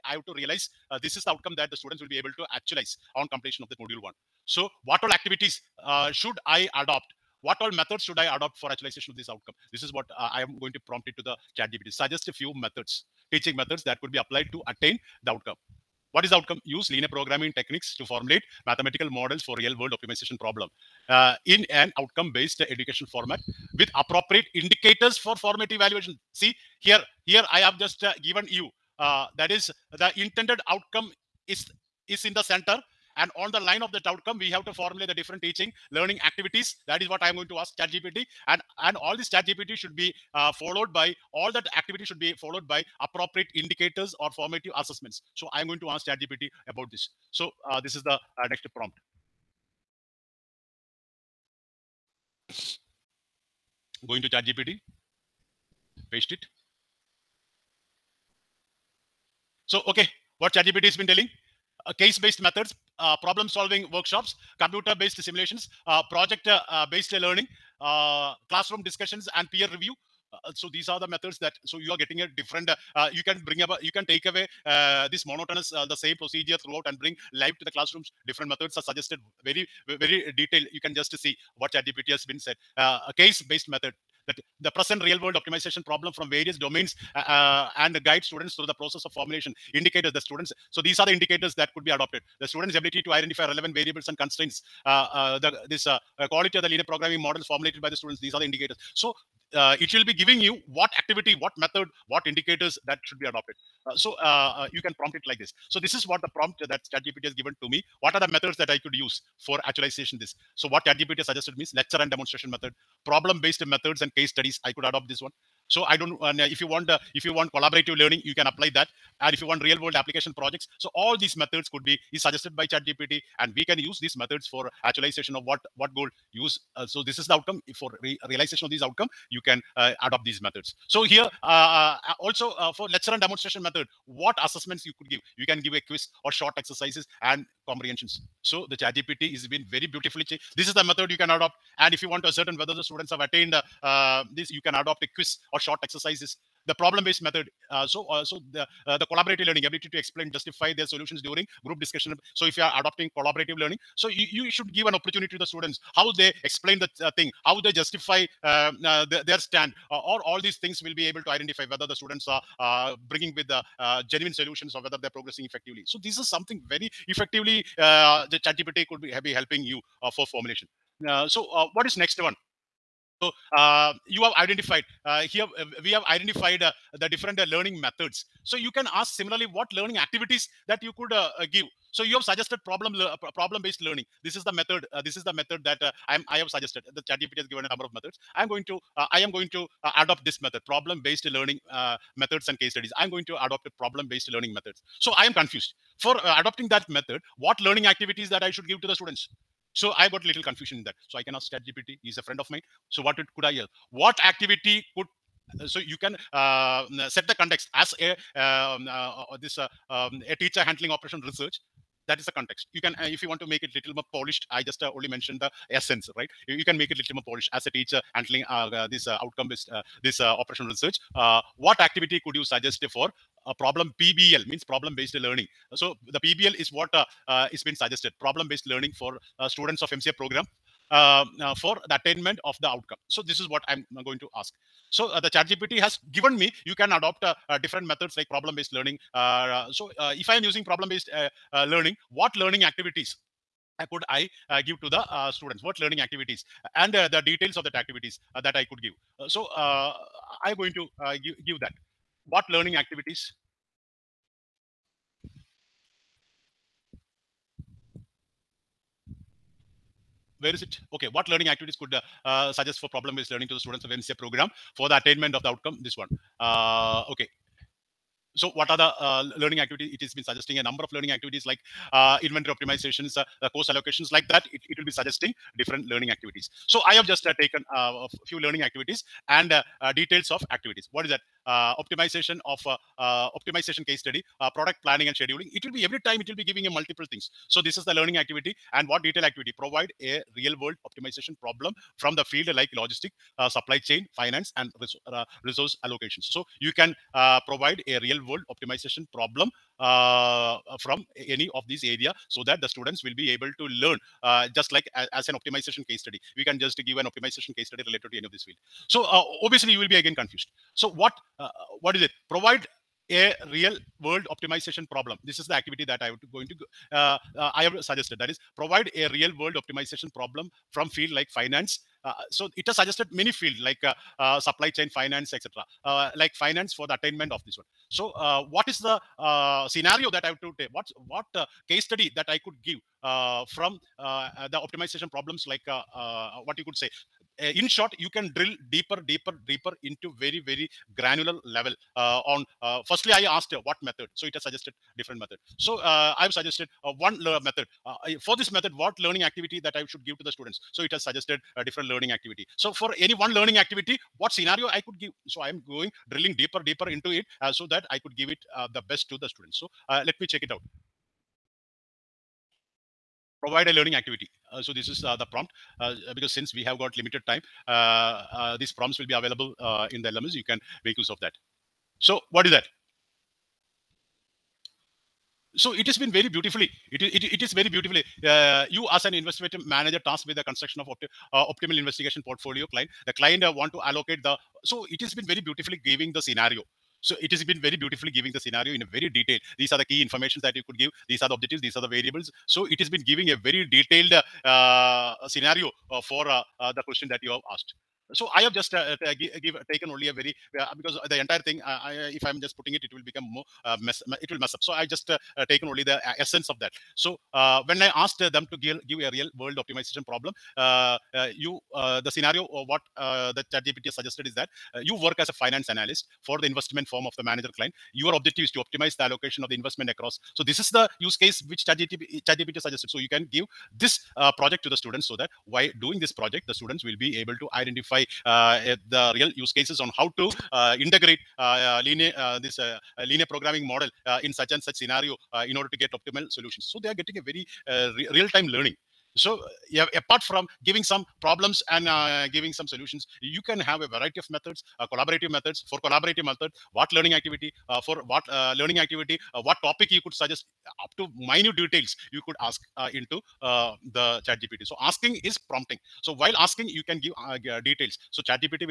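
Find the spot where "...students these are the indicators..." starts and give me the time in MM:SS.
01:37.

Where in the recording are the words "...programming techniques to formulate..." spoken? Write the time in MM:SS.
00:17.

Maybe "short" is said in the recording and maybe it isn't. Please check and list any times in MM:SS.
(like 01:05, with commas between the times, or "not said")
02:16, 02:25, 05:37.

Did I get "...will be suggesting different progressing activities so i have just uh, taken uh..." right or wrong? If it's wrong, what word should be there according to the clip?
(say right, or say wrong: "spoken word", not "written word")
wrong: "learning", not "progressing".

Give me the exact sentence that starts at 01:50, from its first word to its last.
So what ChatGPT has suggested means lecture and demonstration method, problem-based methods and case studies.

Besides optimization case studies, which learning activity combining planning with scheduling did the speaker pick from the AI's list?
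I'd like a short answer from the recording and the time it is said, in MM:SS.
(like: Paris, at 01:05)
Product planning and scheduling, at 04:44.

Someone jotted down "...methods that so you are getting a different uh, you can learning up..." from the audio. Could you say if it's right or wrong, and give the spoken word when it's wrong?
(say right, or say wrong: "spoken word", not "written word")
wrong: "bring", not "learning".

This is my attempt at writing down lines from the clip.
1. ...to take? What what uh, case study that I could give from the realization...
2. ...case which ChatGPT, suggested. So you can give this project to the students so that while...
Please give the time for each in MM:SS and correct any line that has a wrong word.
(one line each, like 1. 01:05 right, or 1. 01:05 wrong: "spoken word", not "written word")
1. 05:30 wrong: "optimization", not "realization"
2. 07:01 right.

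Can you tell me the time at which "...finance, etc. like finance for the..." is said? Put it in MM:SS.
05:24.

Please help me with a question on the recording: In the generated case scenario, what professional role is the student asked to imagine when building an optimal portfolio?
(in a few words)
Investment manager.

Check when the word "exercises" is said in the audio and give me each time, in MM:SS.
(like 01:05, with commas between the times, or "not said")
02:16, 02:25.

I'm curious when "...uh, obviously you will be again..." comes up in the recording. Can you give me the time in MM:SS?
05:09.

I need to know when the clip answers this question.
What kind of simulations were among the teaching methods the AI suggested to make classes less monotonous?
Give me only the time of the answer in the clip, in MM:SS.
01:04.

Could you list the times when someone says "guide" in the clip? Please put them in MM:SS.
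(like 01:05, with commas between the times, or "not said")
01:28.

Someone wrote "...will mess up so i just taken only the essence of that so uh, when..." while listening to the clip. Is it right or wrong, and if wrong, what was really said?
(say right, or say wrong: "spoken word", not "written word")
right.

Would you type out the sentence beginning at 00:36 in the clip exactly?
That is what I am going to ask ChatGPT.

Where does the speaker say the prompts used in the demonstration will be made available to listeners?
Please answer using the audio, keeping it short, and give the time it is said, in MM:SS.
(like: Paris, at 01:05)
The LMS, at 06:10.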